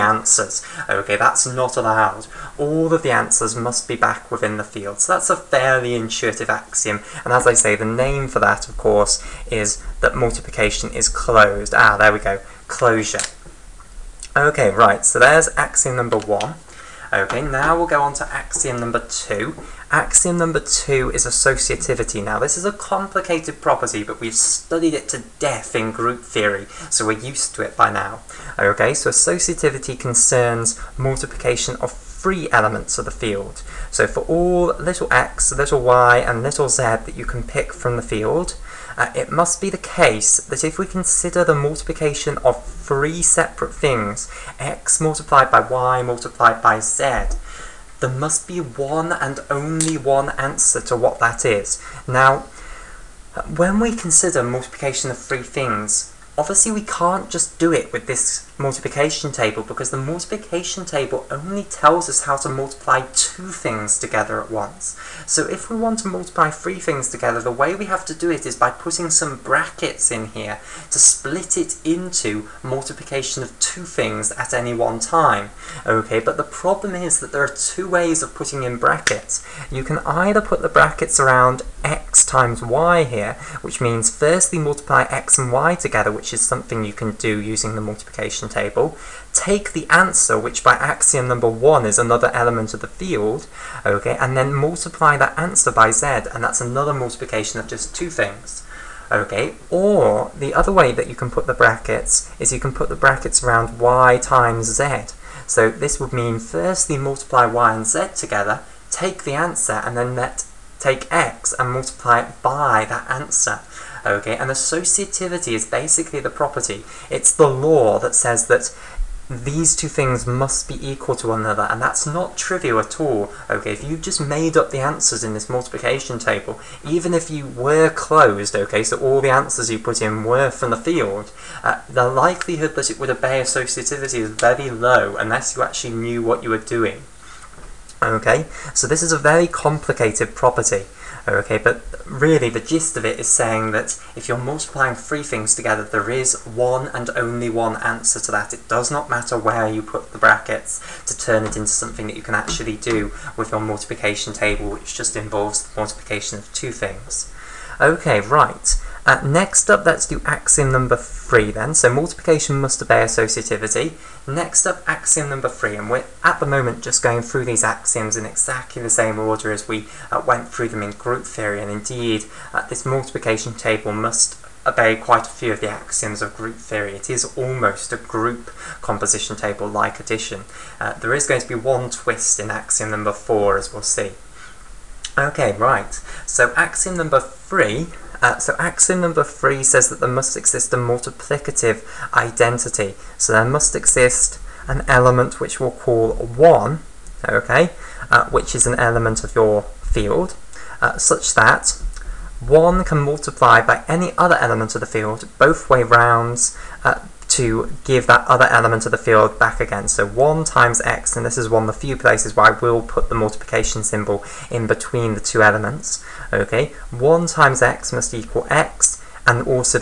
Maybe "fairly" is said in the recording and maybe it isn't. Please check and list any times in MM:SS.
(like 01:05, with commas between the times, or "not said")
00:05.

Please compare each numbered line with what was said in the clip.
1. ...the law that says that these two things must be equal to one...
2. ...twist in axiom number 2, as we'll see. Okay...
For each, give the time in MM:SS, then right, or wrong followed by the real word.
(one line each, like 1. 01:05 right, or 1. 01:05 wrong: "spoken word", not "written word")
1. 01:57 right
2. 03:01 wrong: "4", not "2".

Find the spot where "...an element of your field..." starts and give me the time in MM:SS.
03:18.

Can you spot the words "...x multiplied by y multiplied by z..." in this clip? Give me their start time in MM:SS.
00:44.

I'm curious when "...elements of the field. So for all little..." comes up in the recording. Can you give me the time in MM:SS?
00:32.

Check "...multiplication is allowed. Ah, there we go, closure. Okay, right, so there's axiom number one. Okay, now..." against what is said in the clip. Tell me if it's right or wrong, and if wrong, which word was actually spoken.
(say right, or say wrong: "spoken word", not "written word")
wrong: "closed", not "allowed".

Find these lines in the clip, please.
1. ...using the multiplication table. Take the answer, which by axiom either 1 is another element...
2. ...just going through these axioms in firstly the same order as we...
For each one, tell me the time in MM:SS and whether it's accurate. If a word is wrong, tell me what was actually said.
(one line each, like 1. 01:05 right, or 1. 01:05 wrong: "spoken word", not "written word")
1. 01:27 wrong: "number", not "either"
2. 02:46 wrong: "exactly", not "firstly".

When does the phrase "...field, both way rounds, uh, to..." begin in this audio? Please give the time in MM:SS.
03:24.